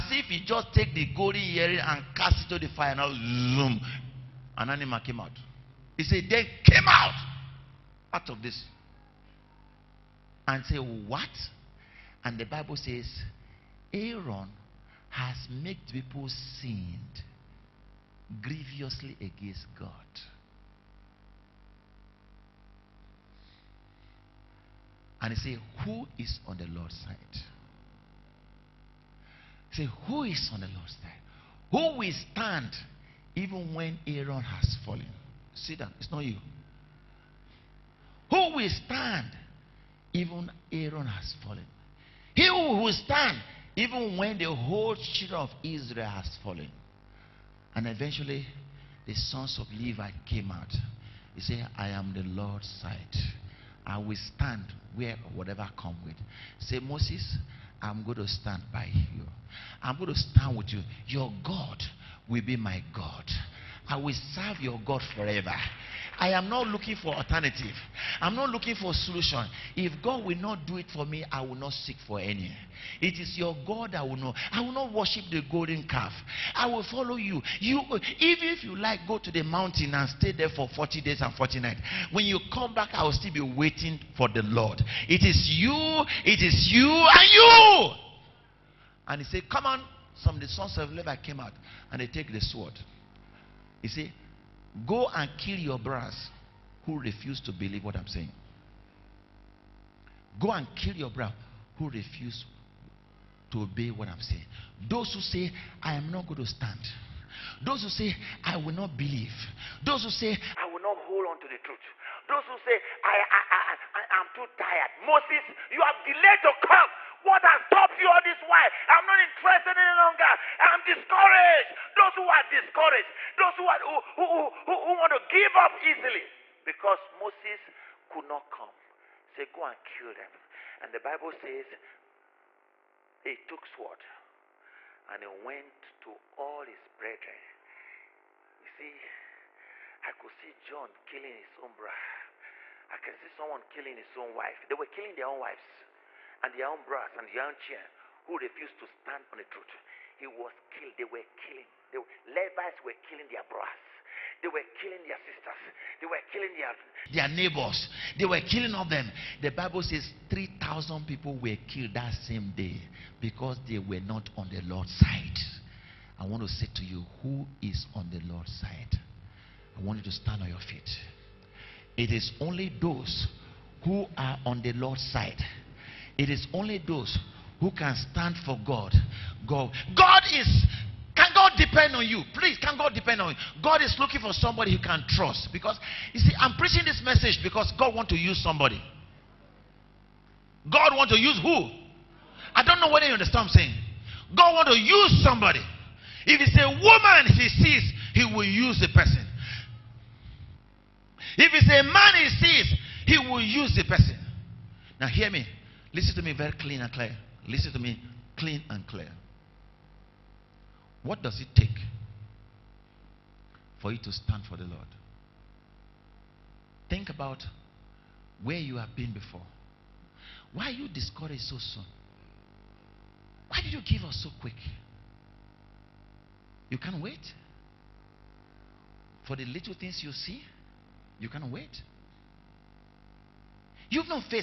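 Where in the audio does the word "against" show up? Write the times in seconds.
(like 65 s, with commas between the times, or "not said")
19 s.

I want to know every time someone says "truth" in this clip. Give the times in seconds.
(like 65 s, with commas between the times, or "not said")
111 s, 149 s.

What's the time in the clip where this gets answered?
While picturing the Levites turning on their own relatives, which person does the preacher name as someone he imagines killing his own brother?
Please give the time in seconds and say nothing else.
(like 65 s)
140 s.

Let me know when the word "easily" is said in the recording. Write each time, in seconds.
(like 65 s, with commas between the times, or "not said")
125 s.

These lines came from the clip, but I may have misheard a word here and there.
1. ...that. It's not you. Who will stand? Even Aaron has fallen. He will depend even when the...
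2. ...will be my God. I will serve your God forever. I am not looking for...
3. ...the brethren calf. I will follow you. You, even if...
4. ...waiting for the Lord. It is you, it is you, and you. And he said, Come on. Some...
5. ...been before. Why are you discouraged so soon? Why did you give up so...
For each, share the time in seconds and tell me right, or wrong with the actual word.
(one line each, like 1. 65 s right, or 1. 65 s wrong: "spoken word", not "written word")
1. 35 s wrong: "stand", not "depend"
2. 62 s right
3. 75 s wrong: "golden", not "brethren"
4. 83 s right
5. 218 s right.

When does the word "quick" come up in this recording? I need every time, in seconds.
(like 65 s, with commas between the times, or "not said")
224 s.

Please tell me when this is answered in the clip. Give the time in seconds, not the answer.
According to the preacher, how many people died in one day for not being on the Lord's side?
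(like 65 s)
160 s.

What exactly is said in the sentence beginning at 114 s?
Moses, you have delayed to come.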